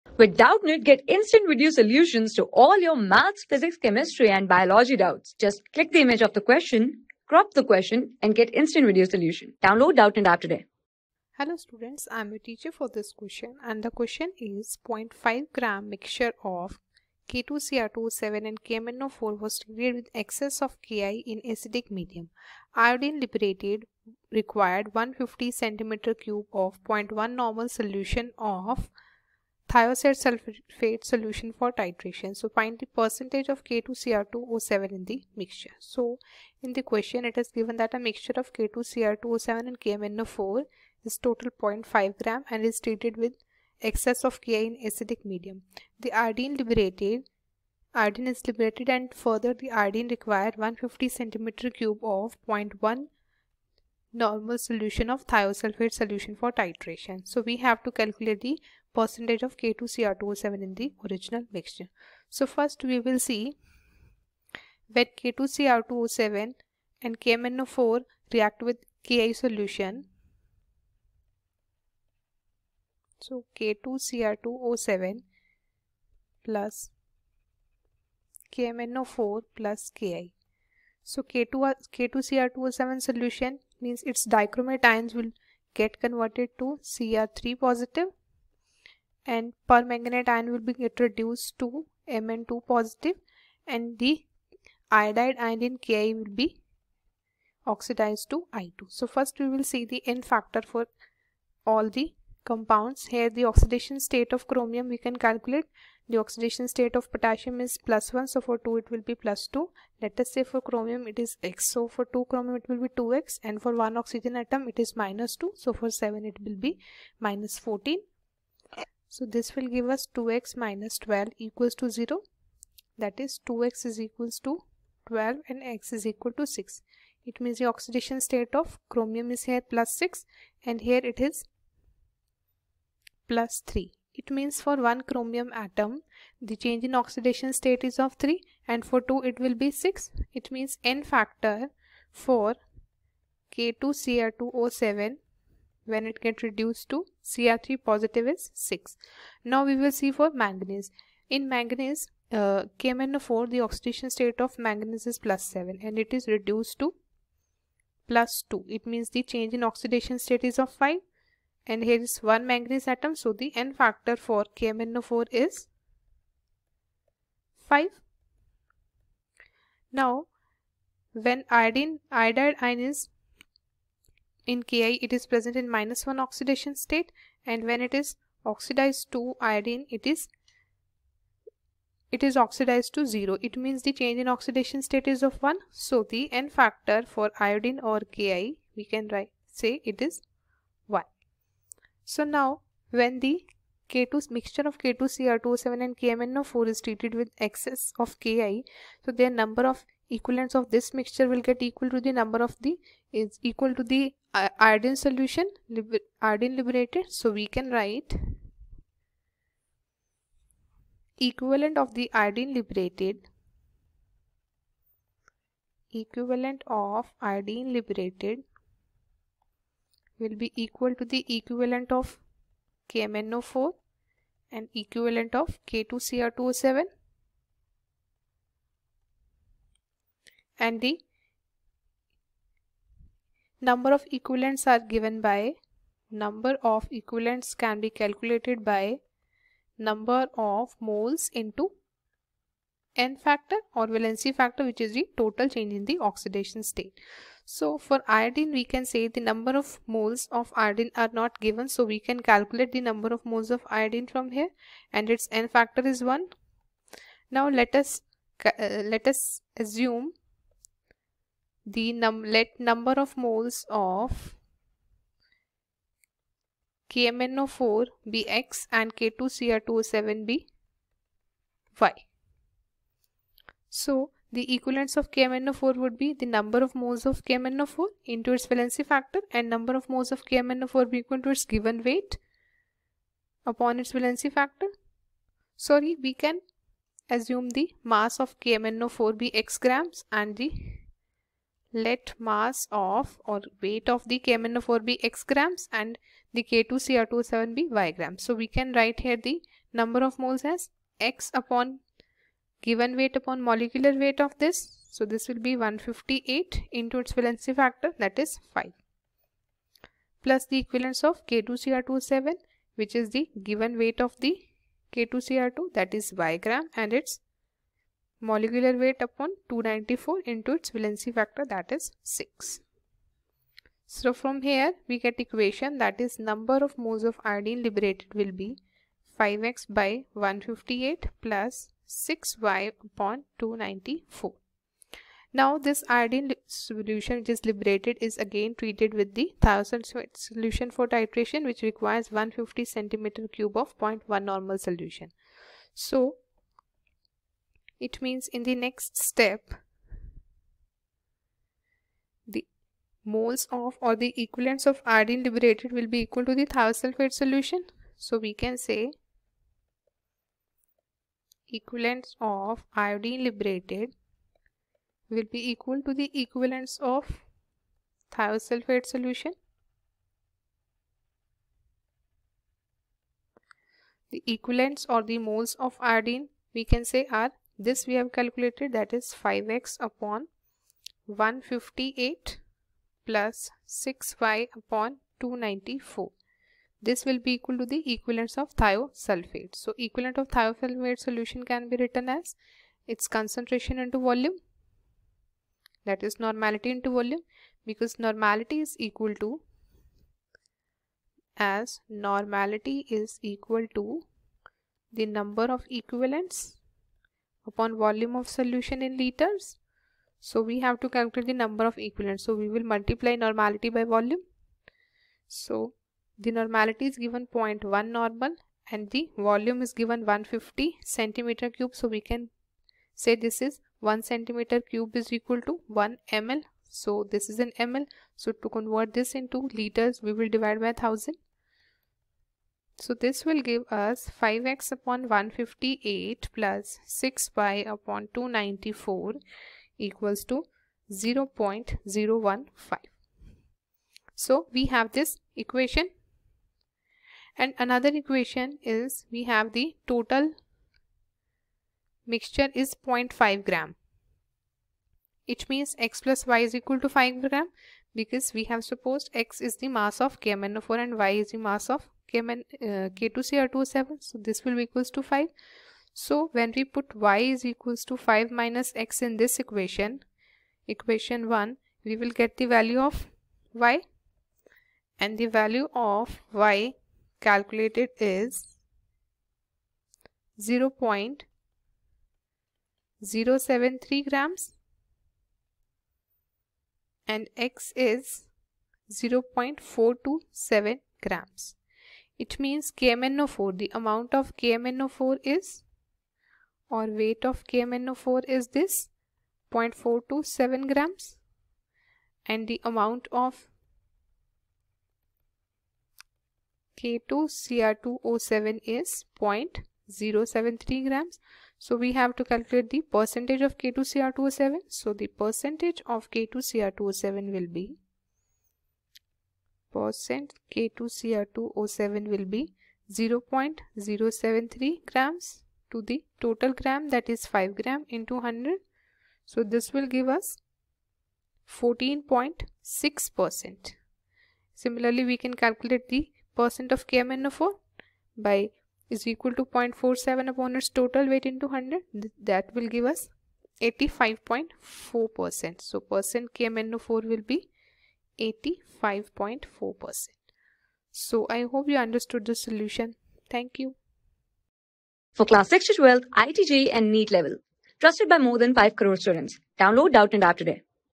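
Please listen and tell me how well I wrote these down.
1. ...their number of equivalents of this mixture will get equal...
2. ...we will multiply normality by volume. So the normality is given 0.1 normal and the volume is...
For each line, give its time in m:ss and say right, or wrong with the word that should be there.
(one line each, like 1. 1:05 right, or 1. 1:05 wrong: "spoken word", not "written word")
1. 3:19 right
2. 6:52 right.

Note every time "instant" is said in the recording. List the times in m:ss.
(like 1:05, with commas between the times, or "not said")
0:01, 0:08.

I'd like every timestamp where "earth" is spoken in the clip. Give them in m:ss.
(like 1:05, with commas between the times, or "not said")
not said.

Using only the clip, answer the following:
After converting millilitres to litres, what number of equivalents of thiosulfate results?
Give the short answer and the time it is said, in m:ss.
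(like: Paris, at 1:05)
0.015, at 7:20.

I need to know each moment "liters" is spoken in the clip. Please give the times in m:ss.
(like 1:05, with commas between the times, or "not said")
6:48, 7:09.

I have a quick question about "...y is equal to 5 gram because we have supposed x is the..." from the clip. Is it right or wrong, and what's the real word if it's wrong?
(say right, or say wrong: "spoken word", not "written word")
right.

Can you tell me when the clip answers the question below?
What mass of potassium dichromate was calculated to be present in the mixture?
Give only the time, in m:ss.
8:00.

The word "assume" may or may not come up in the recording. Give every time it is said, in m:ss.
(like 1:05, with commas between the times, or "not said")
4:19, 4:47.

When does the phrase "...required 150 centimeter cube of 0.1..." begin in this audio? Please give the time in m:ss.
0:50.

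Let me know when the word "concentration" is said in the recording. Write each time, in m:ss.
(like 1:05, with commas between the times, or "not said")
6:33.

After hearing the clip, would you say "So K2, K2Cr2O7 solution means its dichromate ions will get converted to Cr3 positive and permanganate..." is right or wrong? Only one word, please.
right.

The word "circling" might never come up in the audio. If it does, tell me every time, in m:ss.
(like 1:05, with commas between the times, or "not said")
not said.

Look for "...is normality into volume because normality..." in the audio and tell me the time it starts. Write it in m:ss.
6:36.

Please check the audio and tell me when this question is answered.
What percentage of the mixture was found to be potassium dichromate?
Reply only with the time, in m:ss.
8:51.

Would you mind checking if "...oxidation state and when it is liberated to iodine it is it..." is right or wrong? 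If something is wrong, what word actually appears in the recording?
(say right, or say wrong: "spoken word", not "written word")
wrong: "oxidized", not "liberated".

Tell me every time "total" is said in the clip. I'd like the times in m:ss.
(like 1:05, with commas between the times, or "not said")
0:41, 4:05, 7:29, 8:46, 9:00.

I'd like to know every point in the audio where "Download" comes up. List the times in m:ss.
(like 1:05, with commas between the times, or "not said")
0:09, 9:19.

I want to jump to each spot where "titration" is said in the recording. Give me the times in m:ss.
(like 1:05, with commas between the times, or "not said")
0:31, 0:56, 5:40.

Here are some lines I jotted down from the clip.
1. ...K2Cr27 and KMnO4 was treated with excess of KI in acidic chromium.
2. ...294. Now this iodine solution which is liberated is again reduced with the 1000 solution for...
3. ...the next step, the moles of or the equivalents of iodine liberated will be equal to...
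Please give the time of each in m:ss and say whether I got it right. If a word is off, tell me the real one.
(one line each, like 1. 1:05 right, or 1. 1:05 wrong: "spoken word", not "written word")
1. 0:17 wrong: "medium", not "chromium"
2. 5:33 wrong: "treated", not "reduced"
3. 5:48 right.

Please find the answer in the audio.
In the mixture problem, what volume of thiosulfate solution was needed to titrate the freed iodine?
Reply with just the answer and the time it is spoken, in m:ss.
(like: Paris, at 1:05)
150 cm3, at 0:24.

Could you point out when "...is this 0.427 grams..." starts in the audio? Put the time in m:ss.
8:18.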